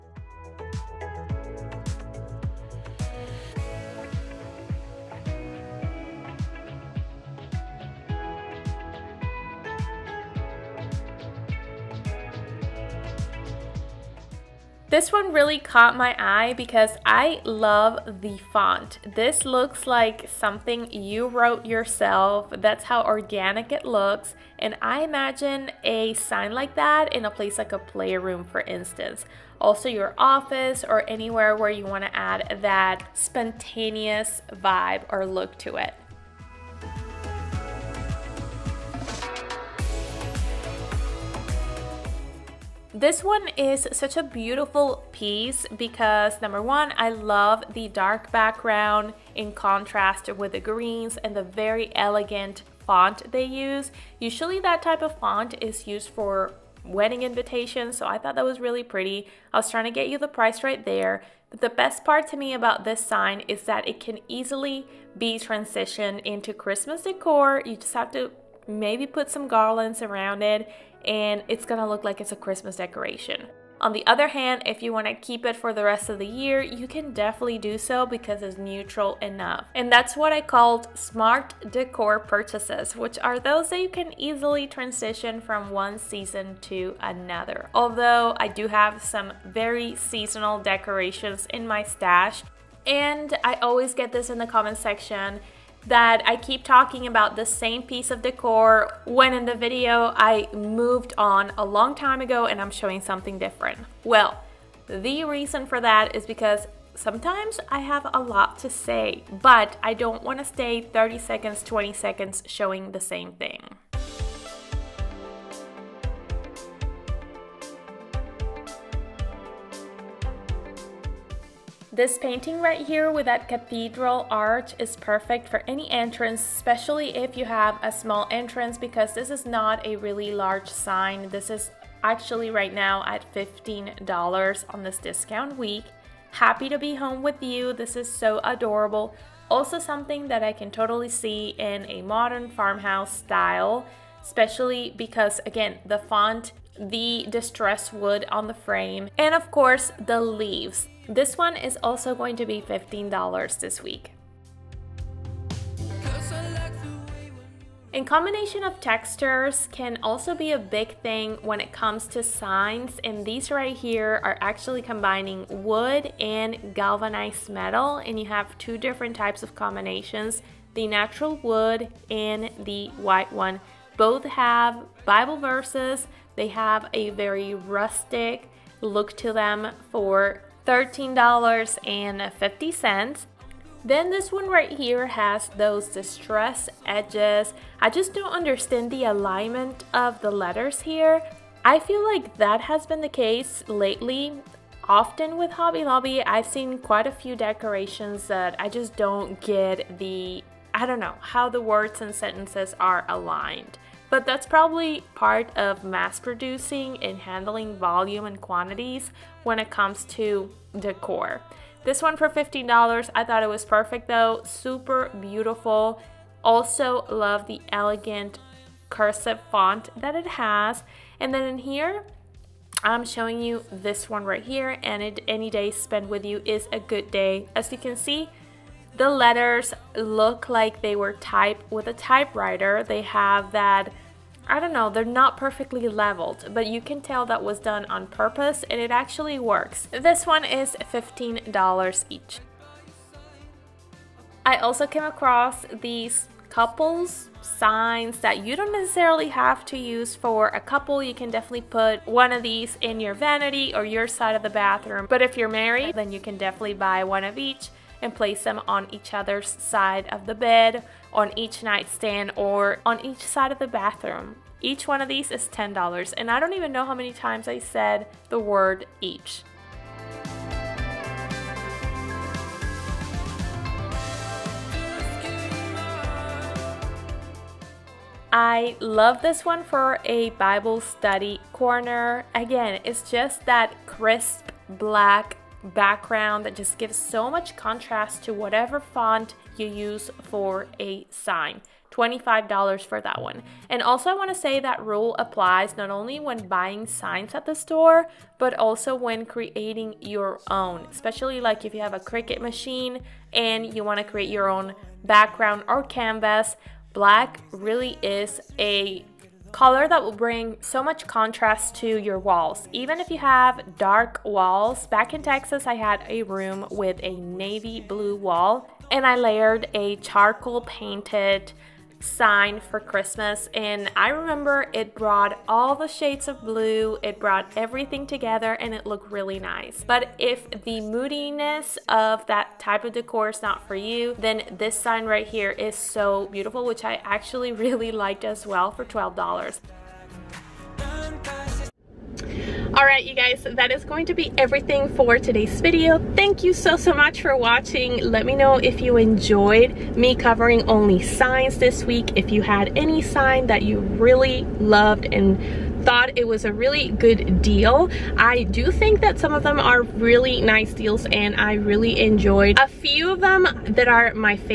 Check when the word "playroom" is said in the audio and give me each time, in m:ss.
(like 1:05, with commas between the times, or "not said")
0:27.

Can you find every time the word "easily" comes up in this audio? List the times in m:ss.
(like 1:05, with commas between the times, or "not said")
1:04, 1:24.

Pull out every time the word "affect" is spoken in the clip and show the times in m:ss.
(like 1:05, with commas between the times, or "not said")
not said.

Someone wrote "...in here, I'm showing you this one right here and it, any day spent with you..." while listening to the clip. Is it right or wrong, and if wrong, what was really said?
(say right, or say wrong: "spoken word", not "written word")
right.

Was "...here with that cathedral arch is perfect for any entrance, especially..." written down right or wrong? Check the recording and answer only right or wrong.
right.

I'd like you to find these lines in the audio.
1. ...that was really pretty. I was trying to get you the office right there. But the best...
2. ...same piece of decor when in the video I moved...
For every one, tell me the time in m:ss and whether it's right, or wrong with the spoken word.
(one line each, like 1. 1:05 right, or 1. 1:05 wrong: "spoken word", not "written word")
1. 0:58 wrong: "price", not "office"
2. 1:37 right.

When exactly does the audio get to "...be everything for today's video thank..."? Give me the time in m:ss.
5:44.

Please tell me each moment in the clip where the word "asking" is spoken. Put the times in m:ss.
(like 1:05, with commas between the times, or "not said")
not said.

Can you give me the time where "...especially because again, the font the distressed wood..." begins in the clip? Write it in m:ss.
2:24.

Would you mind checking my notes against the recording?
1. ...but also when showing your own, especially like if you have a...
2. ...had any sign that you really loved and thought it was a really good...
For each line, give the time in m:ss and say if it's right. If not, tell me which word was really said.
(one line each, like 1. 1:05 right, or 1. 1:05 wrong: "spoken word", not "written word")
1. 4:58 wrong: "creating", not "showing"
2. 5:52 right.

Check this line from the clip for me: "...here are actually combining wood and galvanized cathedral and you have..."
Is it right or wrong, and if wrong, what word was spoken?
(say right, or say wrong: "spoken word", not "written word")
wrong: "metal", not "cathedral".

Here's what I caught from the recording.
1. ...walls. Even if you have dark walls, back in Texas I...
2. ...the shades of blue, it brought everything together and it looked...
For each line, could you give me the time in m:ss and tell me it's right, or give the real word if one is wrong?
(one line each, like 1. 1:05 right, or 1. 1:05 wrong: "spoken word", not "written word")
1. 5:12 right
2. 5:25 right.